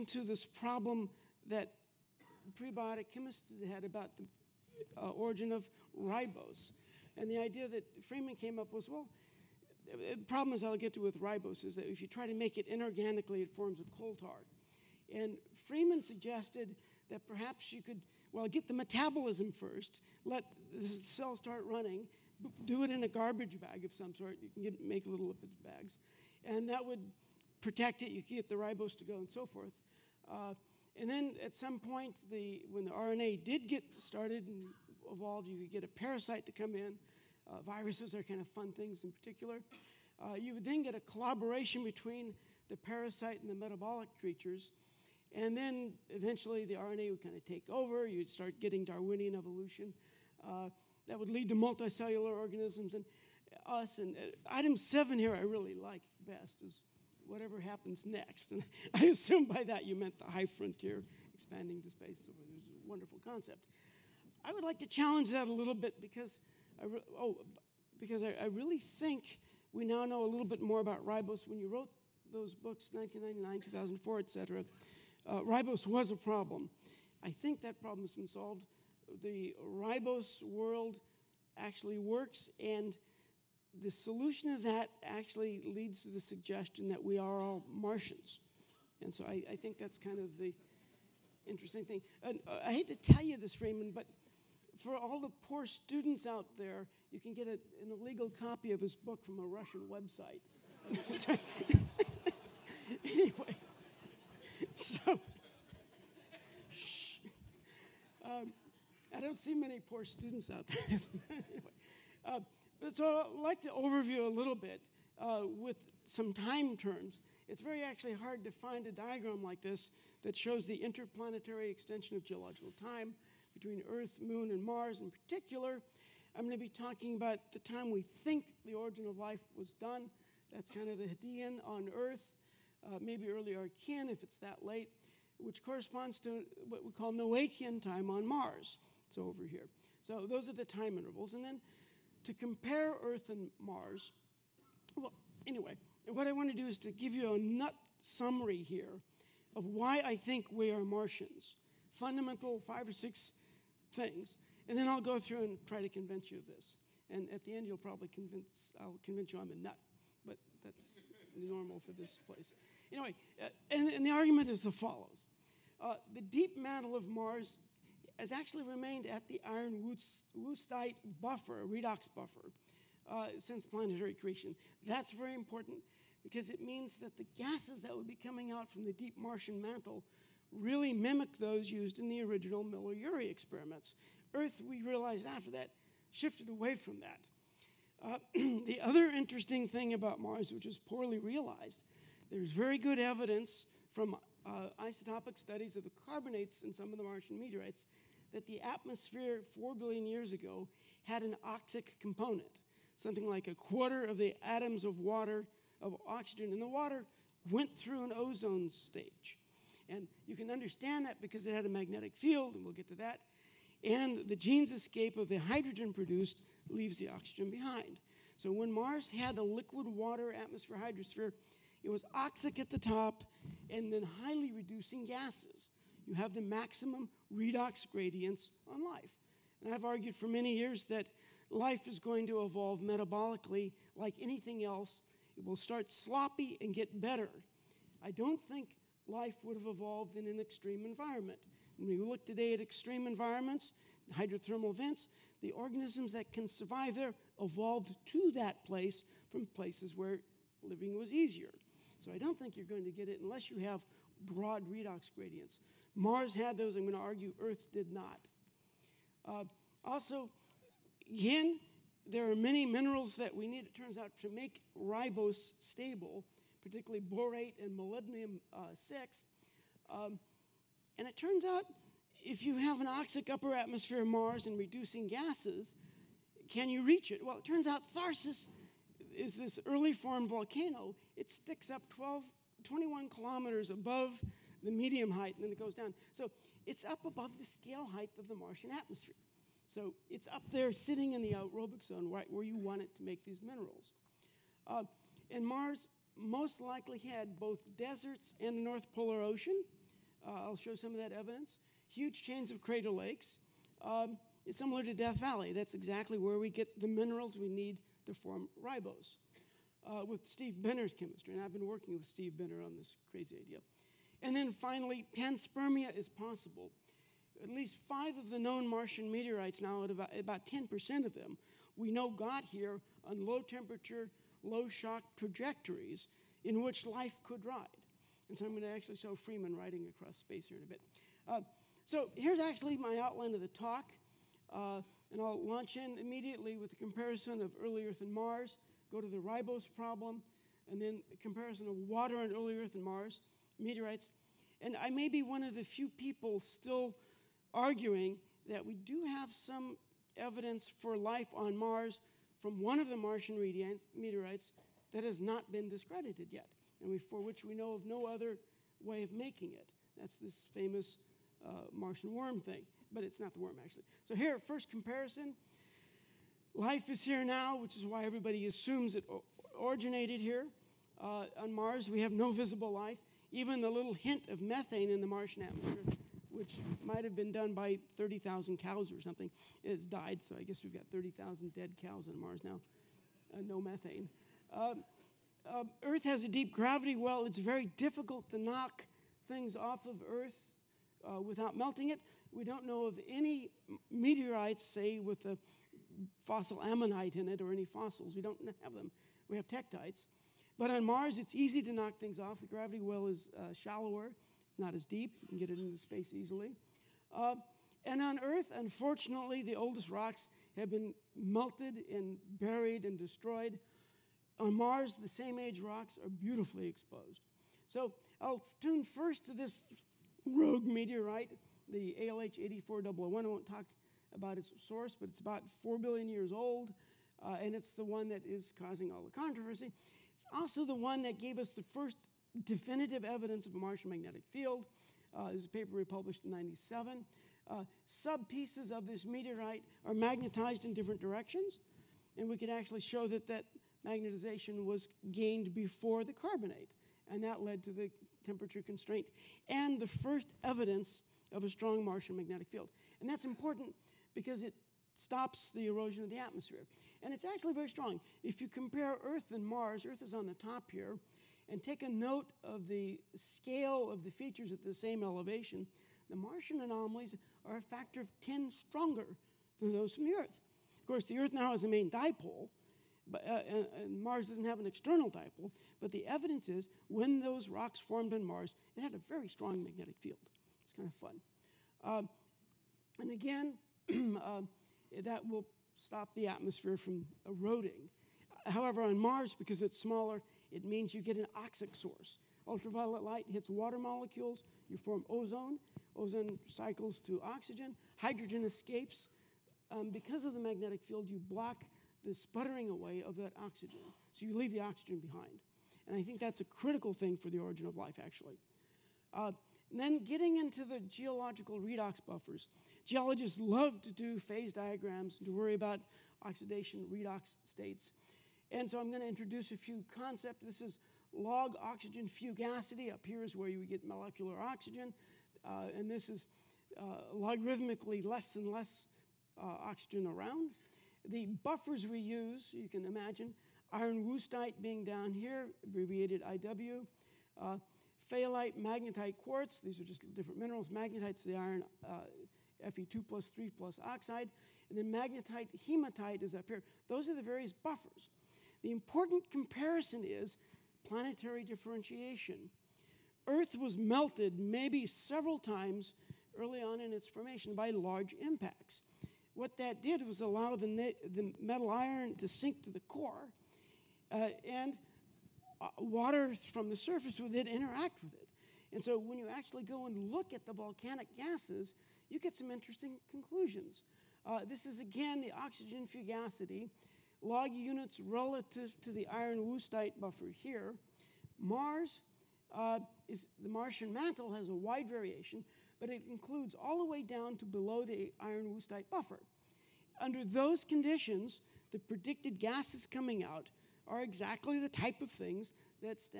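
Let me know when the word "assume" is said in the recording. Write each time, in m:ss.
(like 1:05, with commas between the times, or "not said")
0:59, 6:08.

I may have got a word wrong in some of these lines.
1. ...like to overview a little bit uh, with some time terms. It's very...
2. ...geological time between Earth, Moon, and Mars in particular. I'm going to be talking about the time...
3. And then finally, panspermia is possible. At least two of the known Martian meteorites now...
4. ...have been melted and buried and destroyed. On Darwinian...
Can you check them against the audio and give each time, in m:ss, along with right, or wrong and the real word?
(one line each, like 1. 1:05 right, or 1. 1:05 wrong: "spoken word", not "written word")
1. 1:53 right
2. 2:02 right
3. 5:14 wrong: "five", not "two"
4. 6:50 wrong: "Mars", not "Darwinian".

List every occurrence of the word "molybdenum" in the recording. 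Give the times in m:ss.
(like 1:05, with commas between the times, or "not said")
4:27.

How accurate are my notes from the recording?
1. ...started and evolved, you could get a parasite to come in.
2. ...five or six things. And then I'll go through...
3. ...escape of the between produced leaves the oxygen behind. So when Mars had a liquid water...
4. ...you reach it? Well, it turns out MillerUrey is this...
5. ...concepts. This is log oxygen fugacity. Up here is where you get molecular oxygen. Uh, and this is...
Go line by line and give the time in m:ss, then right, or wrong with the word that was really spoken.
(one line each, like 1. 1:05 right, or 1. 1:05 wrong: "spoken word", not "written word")
1. 0:33 right
2. 2:32 right
3. 3:34 wrong: "hydrogen", not "between"
4. 4:36 wrong: "Tharsis", not "MillerUrey"
5. 8:39 right.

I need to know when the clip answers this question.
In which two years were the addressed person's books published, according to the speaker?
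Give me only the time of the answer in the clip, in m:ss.
1:12.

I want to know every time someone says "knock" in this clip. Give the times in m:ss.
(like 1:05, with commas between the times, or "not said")
6:28, 6:41.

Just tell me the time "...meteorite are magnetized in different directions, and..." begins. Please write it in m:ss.
7:19.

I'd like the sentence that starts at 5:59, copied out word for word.
That's this famous uh, Martian worm thing, but it's not the worm actually.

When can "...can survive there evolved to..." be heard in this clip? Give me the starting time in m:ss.
4:06.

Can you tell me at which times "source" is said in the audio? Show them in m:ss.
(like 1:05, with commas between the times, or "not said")
7:04, 8:11.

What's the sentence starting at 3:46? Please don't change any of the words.
You have the maximum redox gradients on life.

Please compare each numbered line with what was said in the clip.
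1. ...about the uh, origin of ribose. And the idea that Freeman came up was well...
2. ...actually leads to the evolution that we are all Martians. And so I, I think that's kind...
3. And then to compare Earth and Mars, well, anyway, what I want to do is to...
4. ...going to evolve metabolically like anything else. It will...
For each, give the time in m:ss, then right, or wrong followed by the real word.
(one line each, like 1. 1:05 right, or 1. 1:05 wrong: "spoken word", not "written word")
1. 0:03 right
2. 1:25 wrong: "suggestion", not "evolution"
3. 2:21 right
4. 3:51 right.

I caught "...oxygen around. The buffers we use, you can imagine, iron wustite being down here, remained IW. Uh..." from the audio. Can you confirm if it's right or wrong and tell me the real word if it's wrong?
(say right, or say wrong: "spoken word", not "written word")
wrong: "abbreviated", not "remained".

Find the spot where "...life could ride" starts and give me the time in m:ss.
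5:26.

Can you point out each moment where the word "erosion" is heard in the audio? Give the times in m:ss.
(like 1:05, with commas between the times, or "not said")
7:35.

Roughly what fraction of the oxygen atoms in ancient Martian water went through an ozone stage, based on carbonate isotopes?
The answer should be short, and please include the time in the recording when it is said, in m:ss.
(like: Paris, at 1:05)
A quarter, at 3:23.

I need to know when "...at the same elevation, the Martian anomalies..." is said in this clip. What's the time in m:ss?
7:44.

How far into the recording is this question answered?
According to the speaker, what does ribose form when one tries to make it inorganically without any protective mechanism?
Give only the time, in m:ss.
0:13.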